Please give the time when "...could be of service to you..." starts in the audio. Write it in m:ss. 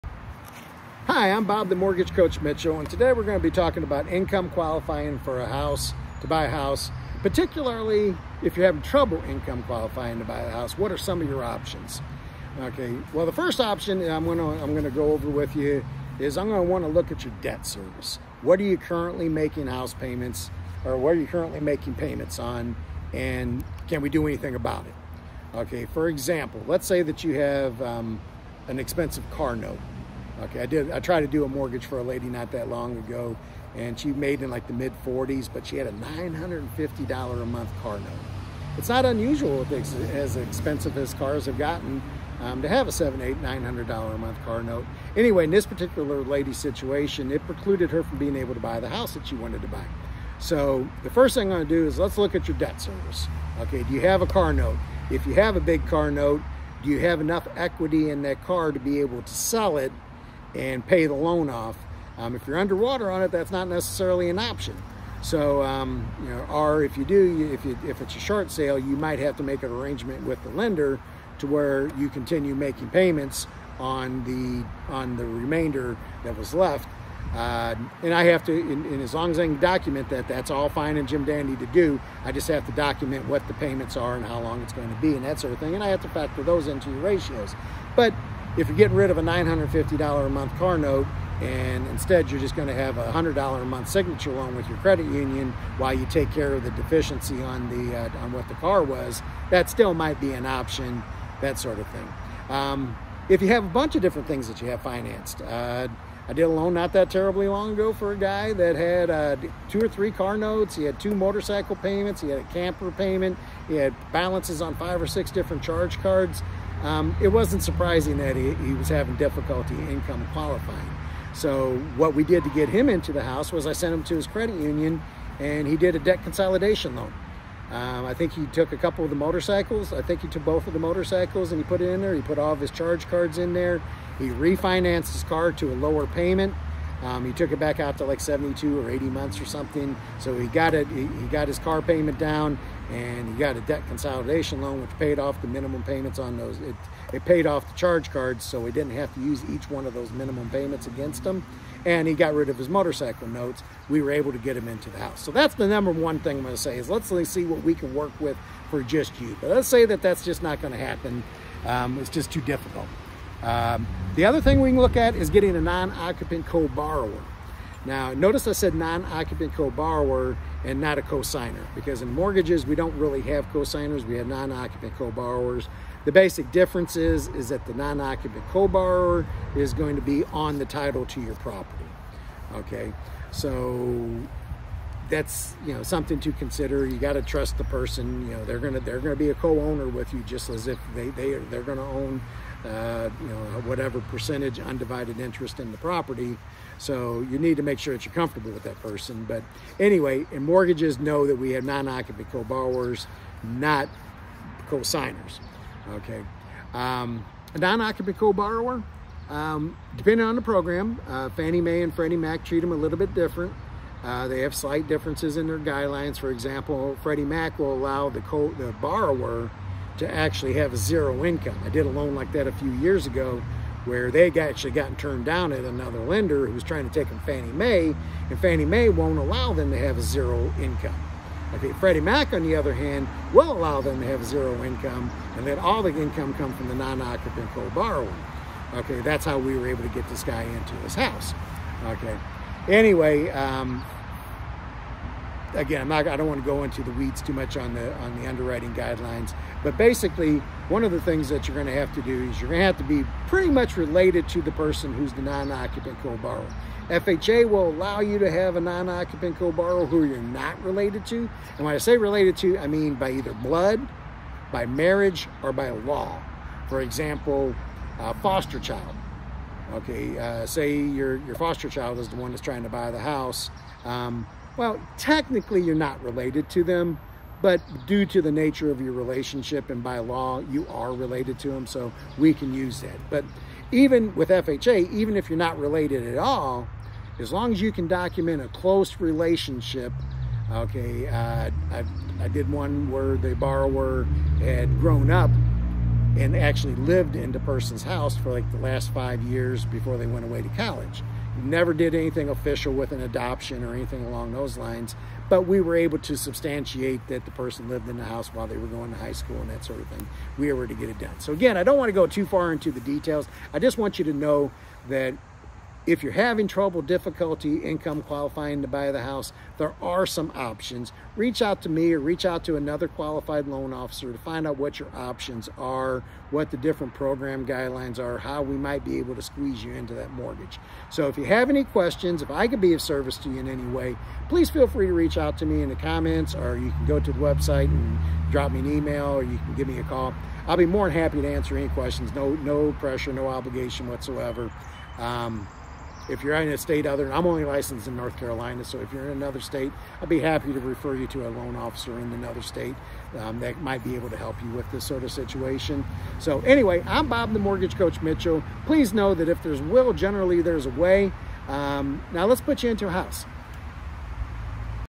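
5:32.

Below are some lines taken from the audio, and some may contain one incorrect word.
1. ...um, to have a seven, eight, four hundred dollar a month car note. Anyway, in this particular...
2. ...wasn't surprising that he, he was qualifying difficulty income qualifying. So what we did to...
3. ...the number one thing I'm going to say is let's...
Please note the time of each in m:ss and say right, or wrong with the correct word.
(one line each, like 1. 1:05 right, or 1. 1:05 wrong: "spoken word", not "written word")
1. 0:42 wrong: "nine", not "four"
2. 1:57 wrong: "having", not "qualifying"
3. 2:35 right.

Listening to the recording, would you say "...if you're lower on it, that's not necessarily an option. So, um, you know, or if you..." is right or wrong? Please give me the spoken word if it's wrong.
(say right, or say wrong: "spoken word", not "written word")
wrong: "underwater", not "lower".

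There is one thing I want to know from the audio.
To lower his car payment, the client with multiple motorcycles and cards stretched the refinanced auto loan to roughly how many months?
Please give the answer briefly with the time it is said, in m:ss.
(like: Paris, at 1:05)
72 or 80 months, at 2:18.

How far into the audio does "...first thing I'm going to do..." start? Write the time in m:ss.
0:51.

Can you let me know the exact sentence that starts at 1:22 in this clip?
I just have to document what the payments are and how long it's going to be and that sort of thing.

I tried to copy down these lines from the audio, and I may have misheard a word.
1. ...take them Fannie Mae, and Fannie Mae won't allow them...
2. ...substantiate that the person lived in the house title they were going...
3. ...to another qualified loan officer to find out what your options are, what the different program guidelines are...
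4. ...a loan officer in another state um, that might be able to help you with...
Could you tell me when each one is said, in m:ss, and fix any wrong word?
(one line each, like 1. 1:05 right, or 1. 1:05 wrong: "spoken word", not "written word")
1. 3:46 right
2. 5:06 wrong: "while", not "title"
3. 5:22 right
4. 5:51 right.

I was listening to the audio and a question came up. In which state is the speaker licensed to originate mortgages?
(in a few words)
North Carolina.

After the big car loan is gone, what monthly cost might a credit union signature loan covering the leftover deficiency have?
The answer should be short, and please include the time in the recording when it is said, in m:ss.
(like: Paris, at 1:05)
$100, at 1:33.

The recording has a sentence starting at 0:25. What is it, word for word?
Okay, for example, let's say that you have um, an expensive car note Okay, I did.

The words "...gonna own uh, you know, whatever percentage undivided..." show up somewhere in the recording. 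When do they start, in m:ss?
3:11.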